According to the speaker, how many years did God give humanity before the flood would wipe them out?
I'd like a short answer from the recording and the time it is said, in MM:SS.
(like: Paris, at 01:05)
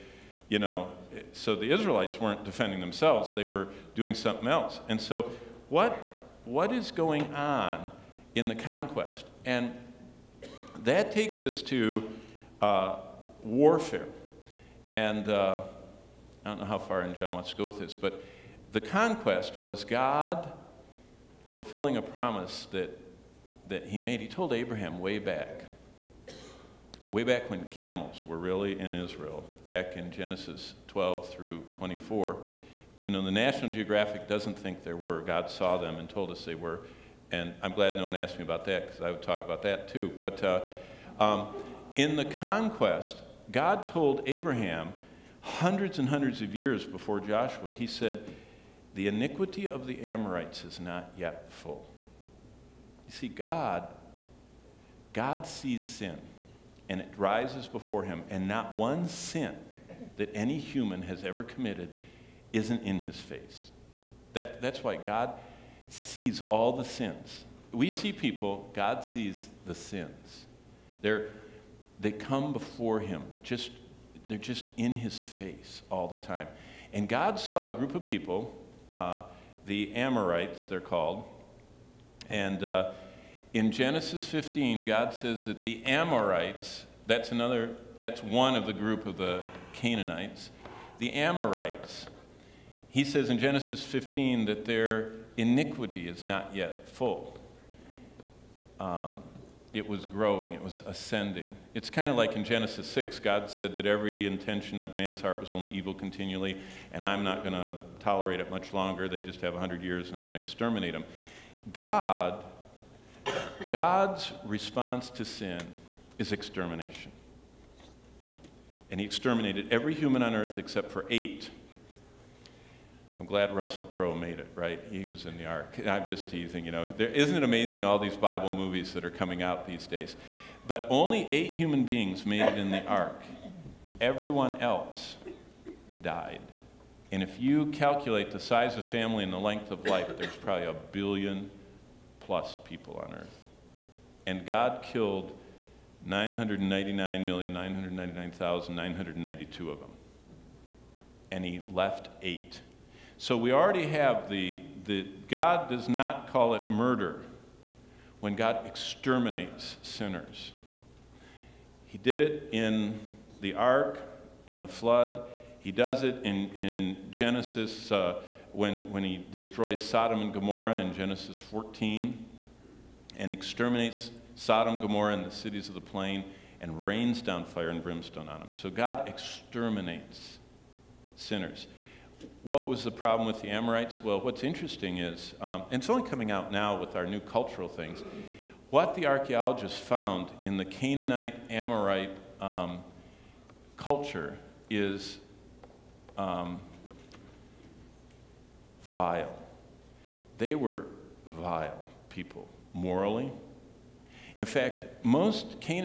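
100, at 01:49.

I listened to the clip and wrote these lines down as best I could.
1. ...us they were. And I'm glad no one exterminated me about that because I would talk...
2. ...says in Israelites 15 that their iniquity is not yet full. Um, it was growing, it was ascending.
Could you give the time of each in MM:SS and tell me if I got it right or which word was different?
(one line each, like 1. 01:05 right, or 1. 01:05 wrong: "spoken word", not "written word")
1. 00:36 wrong: "asked", not "exterminated"
2. 01:33 wrong: "Genesis", not "Israelites".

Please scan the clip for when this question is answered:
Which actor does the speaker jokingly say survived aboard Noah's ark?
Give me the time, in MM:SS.
02:03.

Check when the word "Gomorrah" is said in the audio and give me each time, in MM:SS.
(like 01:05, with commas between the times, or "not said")
02:50, 02:54.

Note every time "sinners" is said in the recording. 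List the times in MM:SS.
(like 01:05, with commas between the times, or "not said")
02:39, 03:01.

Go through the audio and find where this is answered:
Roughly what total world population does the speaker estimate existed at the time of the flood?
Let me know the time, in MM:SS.
02:20.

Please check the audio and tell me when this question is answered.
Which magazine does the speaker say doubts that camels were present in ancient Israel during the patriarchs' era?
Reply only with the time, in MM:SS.
00:33.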